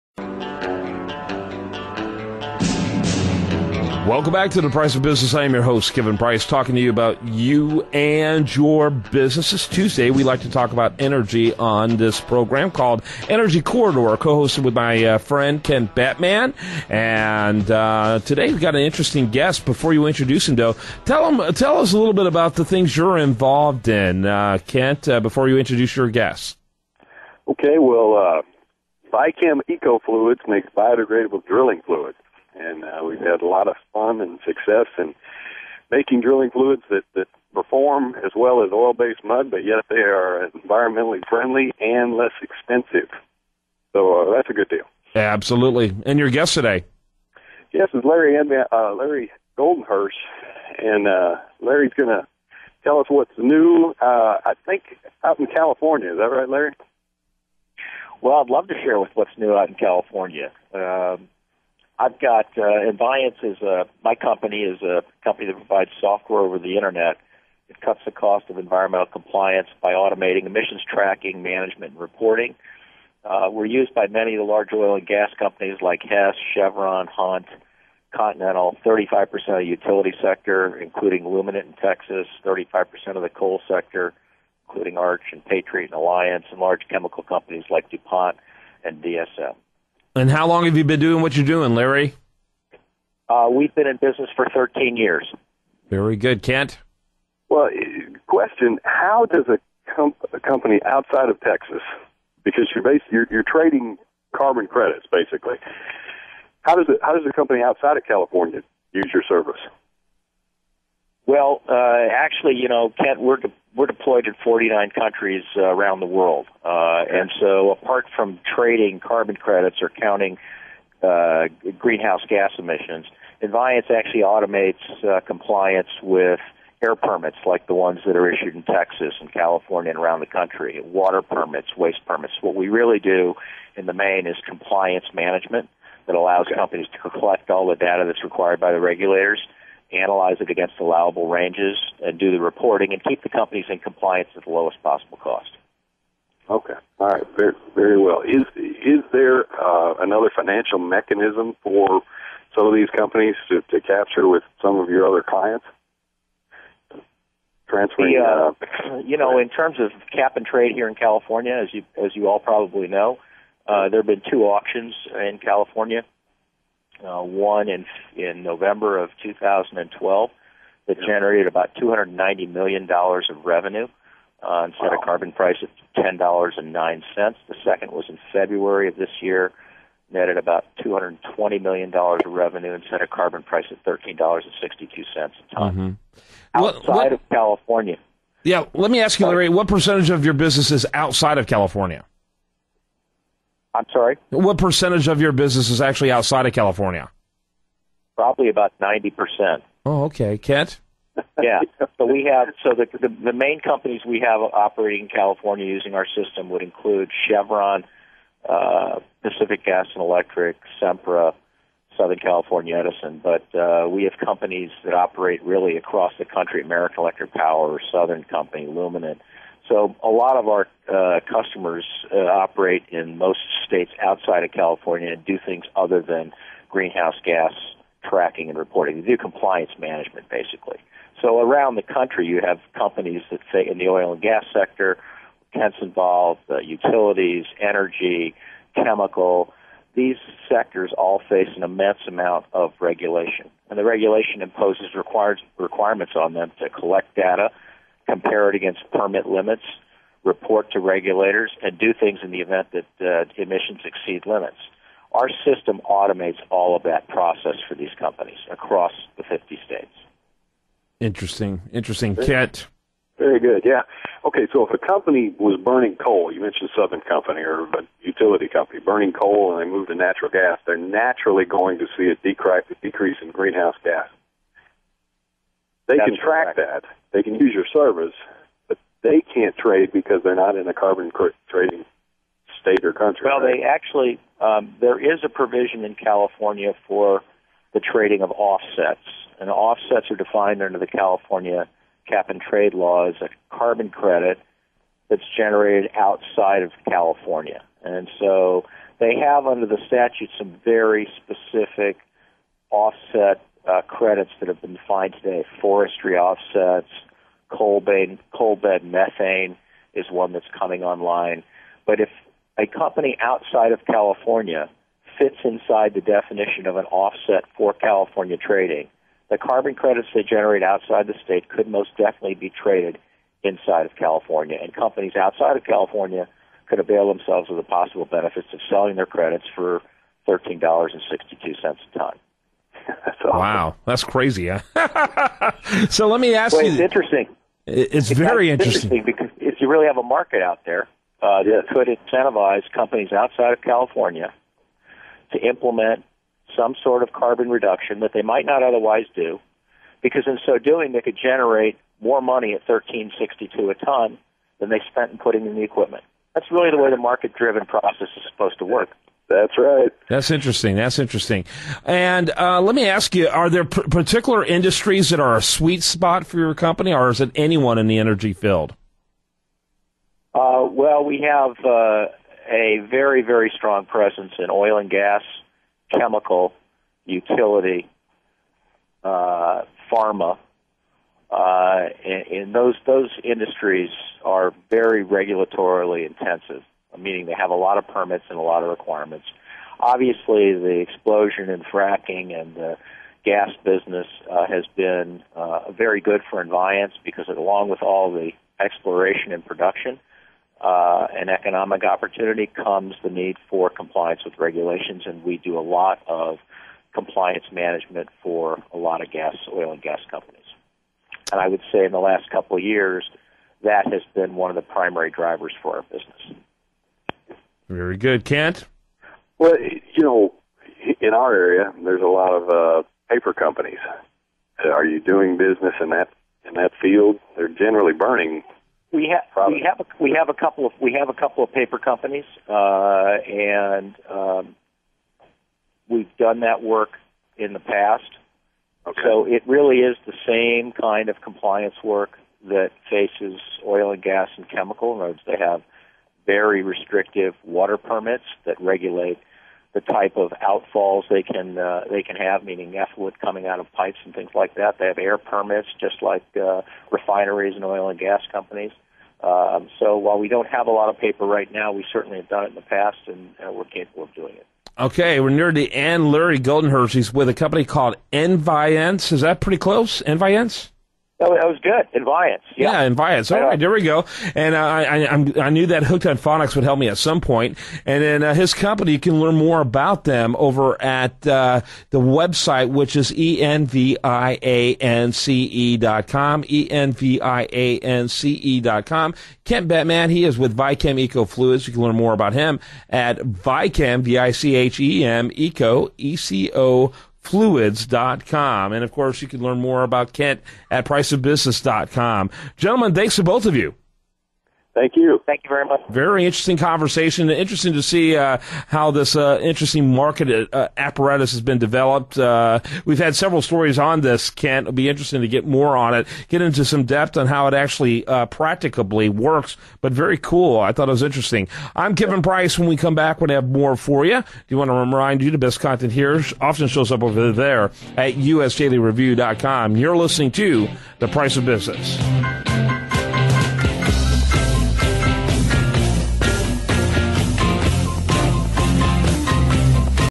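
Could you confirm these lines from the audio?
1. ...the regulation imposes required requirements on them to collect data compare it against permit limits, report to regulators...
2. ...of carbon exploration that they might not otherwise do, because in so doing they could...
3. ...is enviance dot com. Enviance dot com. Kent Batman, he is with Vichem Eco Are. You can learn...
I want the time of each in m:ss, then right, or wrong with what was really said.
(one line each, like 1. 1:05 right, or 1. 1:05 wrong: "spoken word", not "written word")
1. 4:03 right
2. 5:47 wrong: "reduction", not "exploration"
3. 8:02 wrong: "Fluids", not "Are".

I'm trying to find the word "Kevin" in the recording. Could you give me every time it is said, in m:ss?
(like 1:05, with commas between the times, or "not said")
0:05, 8:41.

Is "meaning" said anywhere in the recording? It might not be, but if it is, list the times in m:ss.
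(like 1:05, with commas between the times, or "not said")
6:26, 7:32.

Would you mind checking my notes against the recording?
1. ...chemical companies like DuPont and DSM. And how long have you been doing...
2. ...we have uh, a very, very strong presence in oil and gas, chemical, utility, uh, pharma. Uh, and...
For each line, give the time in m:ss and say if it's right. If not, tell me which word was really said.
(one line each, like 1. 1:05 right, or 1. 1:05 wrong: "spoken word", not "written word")
1. 1:26 right
2. 6:11 right.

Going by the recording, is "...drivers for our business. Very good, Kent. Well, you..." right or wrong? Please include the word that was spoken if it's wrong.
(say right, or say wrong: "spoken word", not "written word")
right.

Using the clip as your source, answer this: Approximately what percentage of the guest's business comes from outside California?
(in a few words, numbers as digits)
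90%.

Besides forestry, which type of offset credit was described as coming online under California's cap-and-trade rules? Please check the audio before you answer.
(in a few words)
Coal bed methane.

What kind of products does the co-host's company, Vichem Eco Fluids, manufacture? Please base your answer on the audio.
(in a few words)
Biodegradable drilling fluids.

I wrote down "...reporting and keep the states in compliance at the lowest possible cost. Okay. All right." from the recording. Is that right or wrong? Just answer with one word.
wrong.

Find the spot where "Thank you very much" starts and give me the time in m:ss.
8:25.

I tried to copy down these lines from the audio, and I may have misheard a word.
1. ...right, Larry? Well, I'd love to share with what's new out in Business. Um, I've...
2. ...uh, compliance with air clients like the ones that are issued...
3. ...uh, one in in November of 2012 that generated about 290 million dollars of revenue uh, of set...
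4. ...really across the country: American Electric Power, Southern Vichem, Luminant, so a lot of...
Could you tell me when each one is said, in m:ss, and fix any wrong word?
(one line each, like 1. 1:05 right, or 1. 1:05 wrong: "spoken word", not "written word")
1. 0:56 wrong: "California", not "Business"
2. 2:05 wrong: "permits", not "clients"
3. 2:47 right
4. 3:35 wrong: "Company", not "Vichem".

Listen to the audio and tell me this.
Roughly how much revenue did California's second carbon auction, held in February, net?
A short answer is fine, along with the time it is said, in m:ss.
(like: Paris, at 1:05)
$220 million, at 3:00.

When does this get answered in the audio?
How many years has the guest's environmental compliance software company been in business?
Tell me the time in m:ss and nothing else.
1:34.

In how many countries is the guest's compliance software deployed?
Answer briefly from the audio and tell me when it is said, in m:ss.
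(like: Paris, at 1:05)
49, at 1:54.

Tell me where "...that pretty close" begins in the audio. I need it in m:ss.
7:49.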